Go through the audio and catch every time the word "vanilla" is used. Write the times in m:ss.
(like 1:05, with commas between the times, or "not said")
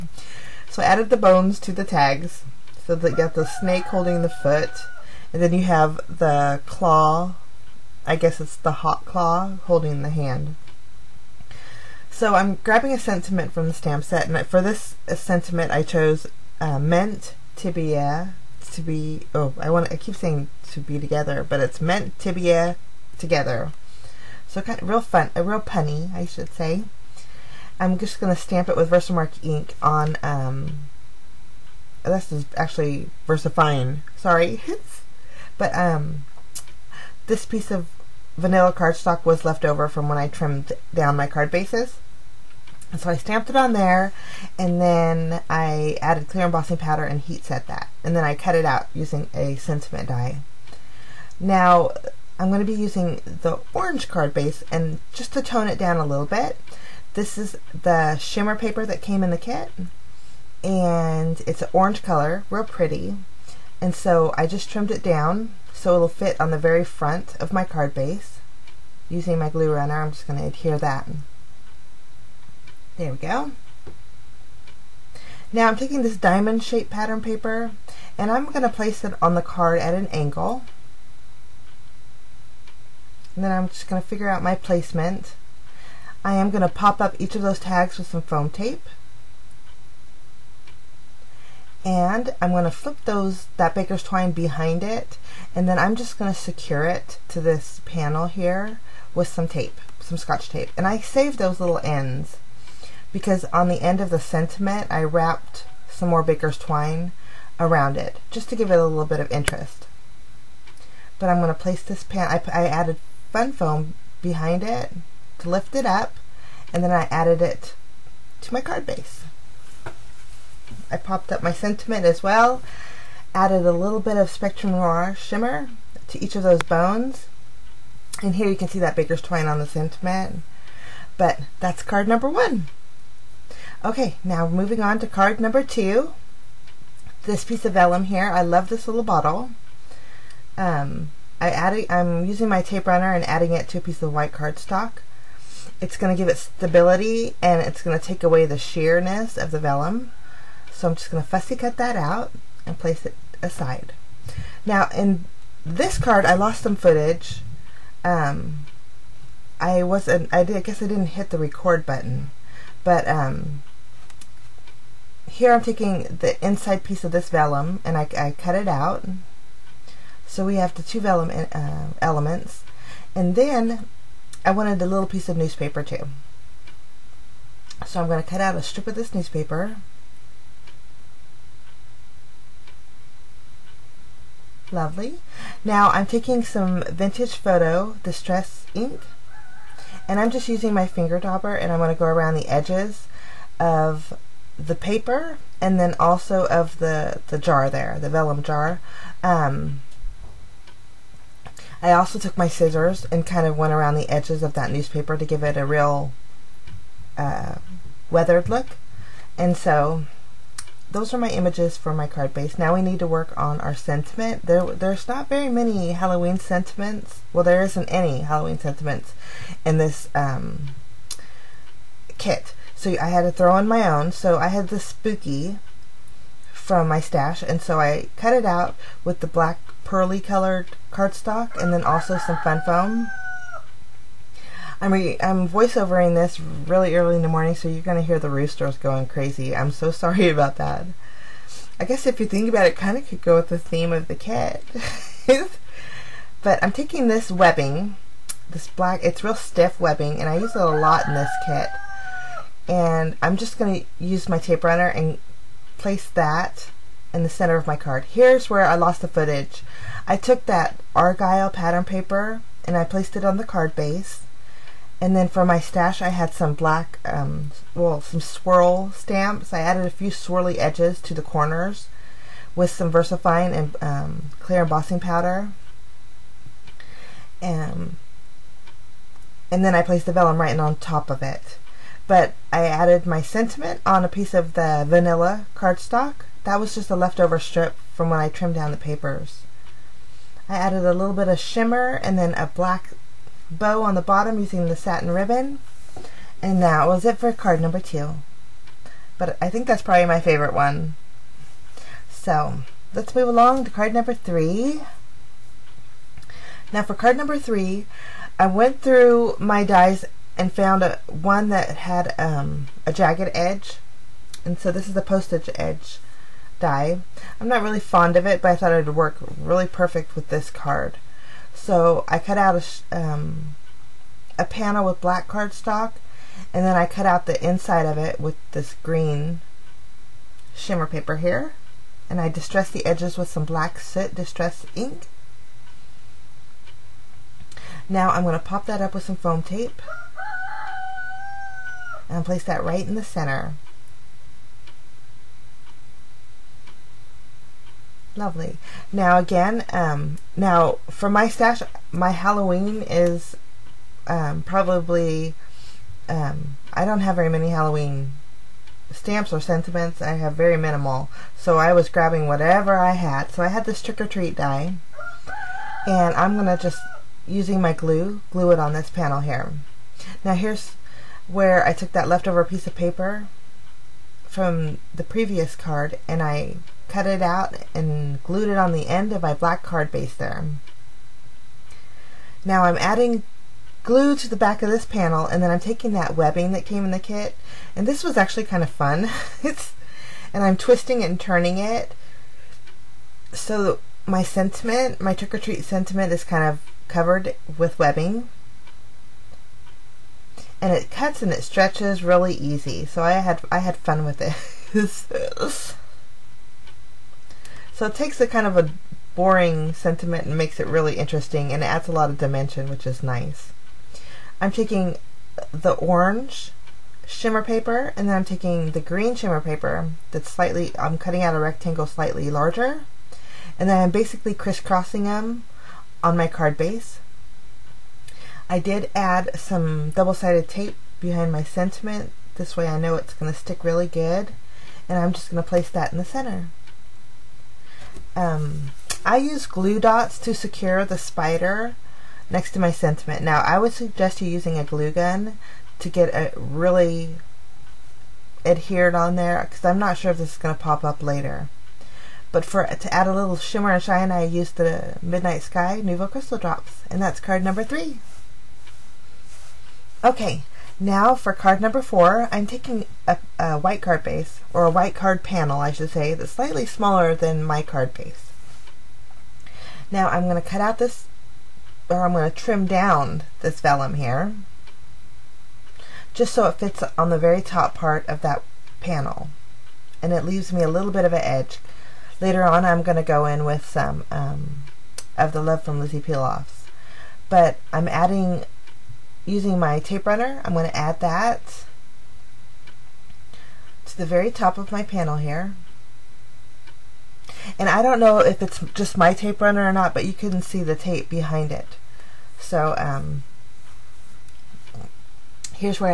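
0:38, 4:44.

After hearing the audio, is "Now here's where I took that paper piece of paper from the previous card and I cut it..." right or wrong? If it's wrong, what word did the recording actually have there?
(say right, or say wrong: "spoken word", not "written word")
wrong: "leftover", not "paper".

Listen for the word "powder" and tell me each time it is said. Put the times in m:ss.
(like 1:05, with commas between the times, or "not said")
0:46, 4:35.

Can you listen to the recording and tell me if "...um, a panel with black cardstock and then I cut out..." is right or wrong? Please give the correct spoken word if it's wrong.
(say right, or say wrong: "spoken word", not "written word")
right.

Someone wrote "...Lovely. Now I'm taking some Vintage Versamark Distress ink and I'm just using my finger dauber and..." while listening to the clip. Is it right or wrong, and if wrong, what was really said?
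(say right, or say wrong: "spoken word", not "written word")
wrong: "Photo", not "Versamark".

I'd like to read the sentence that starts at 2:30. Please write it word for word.
So I'm just going to fussy cut that out and place it aside.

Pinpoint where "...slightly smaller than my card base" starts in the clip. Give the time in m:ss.
7:46.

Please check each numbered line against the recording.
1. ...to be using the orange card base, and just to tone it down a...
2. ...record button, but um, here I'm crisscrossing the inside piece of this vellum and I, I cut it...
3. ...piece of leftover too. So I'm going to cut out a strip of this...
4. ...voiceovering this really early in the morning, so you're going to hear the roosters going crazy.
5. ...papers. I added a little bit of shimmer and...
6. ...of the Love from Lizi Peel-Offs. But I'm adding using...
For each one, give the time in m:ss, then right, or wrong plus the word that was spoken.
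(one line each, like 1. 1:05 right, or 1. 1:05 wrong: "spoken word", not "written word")
1. 0:52 right
2. 2:41 wrong: "taking", not "crisscrossing"
3. 2:55 wrong: "newspaper", not "leftover"
4. 3:55 right
5. 4:48 right
6. 8:05 right.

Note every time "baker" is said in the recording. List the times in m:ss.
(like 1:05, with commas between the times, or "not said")
1:33, 1:46, 2:08.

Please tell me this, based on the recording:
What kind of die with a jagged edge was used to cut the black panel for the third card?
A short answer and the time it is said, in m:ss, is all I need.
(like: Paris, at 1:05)
postage edge die, at 5:15.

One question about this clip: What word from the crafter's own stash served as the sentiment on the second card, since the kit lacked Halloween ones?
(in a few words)
spooky.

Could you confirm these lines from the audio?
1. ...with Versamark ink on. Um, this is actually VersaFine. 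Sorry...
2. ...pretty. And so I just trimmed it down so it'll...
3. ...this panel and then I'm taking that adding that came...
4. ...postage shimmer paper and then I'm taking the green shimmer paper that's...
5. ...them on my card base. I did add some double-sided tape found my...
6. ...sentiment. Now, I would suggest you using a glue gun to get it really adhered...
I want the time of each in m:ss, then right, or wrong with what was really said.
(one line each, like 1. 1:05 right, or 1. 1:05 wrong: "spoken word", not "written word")
1. 0:28 right
2. 1:02 right
3. 6:24 wrong: "webbing", not "adding"
4. 6:55 wrong: "orange", not "postage"
5. 7:05 wrong: "behind", not "found"
6. 7:22 right.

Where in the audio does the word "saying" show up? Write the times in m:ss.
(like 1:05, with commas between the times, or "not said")
0:20.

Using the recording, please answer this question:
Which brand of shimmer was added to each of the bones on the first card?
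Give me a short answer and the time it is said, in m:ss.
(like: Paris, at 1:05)
Spectrum Noir, at 2:04.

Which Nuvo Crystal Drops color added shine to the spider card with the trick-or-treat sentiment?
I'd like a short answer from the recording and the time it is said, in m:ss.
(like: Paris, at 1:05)
Midnight Sky, at 7:35.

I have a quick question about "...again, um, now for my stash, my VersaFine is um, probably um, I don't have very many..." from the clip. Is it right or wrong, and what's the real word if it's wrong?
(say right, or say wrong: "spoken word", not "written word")
wrong: "Halloween", not "VersaFine".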